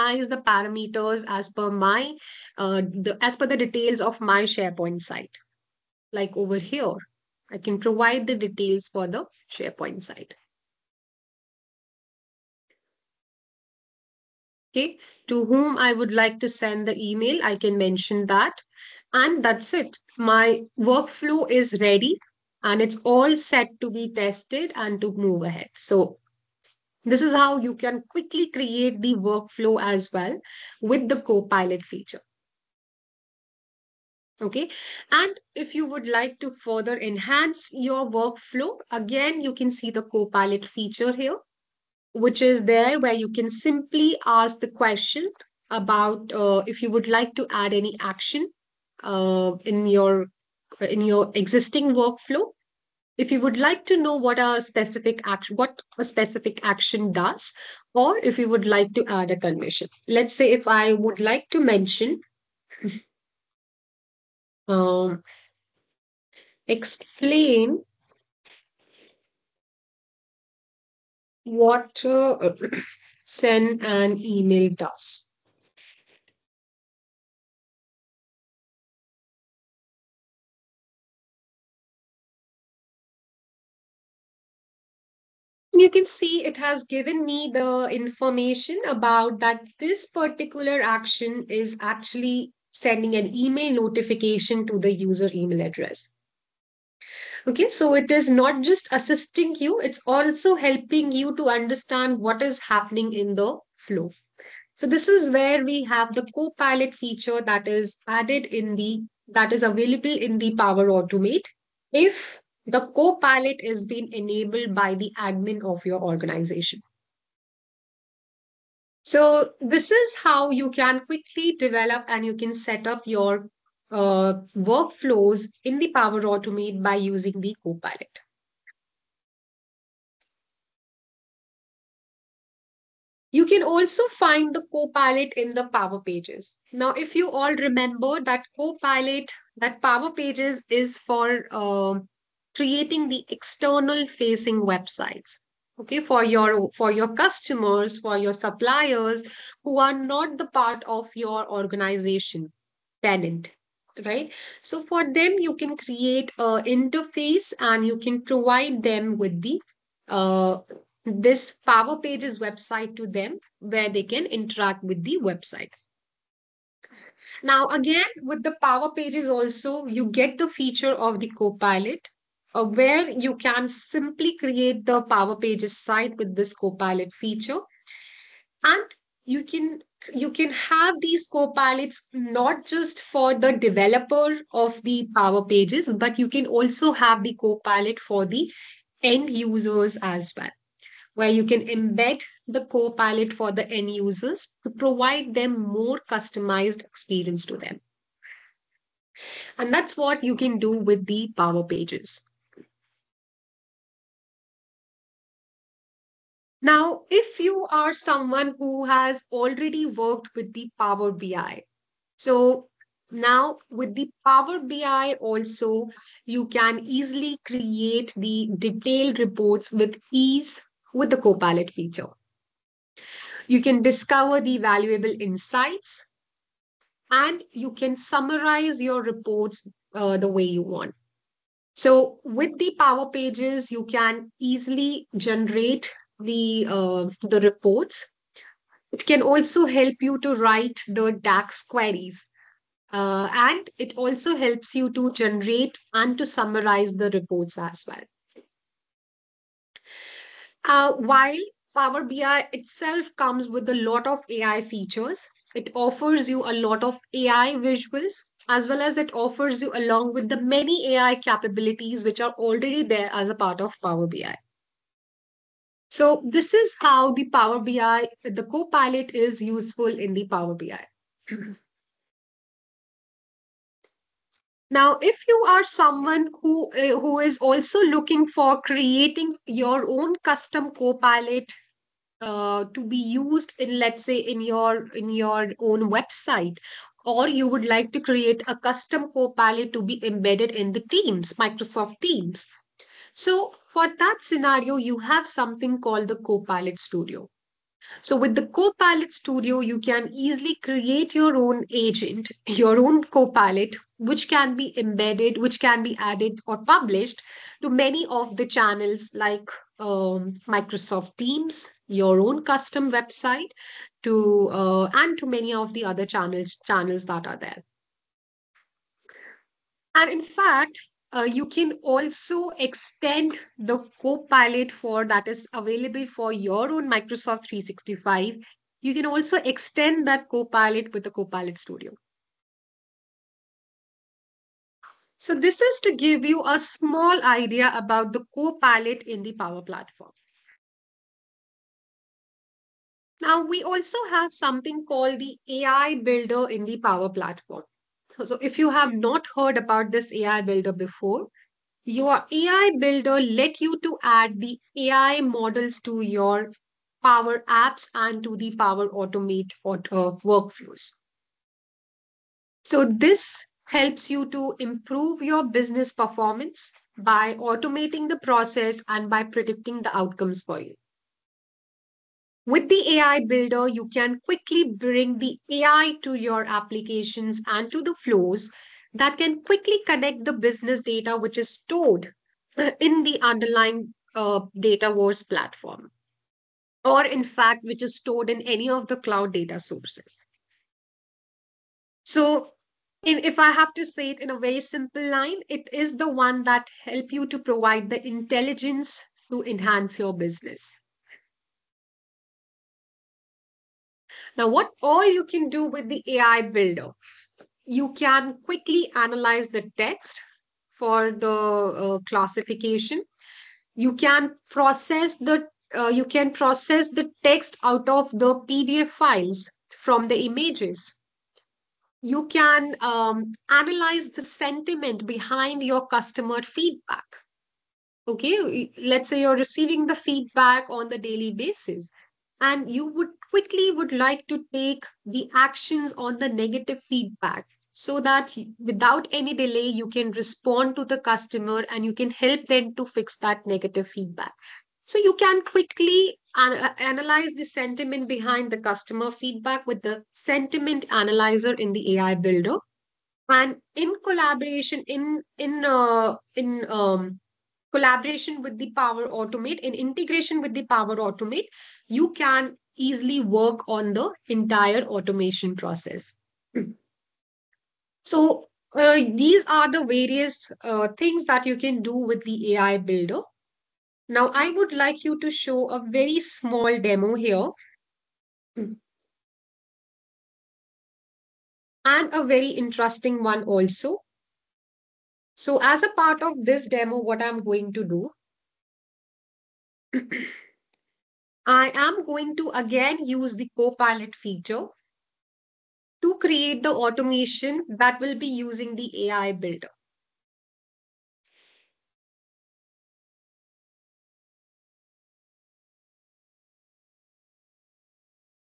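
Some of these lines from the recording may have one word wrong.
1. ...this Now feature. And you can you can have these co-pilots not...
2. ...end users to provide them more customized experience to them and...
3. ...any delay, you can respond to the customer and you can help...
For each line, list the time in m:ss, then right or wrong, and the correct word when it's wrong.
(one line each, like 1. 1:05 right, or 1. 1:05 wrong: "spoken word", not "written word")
1. 2:56 wrong: "Copilot", not "Now"
2. 3:13 right
3. 7:19 right.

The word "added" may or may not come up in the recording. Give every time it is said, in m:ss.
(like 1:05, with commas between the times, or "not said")
1:48, 5:05.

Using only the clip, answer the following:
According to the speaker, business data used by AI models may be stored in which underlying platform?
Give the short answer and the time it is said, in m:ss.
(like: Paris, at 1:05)
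Dataverse, at 6:24.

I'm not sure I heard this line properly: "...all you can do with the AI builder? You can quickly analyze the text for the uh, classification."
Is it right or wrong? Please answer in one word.
right.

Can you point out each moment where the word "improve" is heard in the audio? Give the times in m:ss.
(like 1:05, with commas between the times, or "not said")
6:04.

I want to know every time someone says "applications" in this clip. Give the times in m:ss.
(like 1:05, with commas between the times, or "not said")
6:16.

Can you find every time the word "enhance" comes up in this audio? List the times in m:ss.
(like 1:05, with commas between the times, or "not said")
0:36, 6:39.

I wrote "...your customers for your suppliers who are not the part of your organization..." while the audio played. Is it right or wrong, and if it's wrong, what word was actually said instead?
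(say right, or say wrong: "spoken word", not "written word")
right.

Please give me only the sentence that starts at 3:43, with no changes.
You can discover the valuable insights and you can summarize your reports uh, the way you want.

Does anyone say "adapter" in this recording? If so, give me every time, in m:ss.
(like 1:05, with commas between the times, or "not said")
not said.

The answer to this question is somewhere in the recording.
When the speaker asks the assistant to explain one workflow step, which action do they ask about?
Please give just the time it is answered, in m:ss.
1:13.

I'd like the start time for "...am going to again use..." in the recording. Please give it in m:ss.
8:11.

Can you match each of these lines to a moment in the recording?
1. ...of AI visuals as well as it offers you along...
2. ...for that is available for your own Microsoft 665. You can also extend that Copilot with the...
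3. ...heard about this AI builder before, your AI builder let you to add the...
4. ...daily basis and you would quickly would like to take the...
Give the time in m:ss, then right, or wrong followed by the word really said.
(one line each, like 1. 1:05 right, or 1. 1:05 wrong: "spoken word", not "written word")
1. 4:16 right
2. 5:24 wrong: "365", not "665"
3. 5:49 right
4. 7:10 right.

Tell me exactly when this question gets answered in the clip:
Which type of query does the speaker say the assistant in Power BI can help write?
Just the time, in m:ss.
4:01.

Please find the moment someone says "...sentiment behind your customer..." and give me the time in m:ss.
7:04.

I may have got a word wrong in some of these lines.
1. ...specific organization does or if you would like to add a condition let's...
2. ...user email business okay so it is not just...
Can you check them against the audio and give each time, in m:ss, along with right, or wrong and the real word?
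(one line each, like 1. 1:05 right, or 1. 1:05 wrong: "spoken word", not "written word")
1. 0:56 wrong: "action", not "organization"
2. 1:34 wrong: "address", not "business".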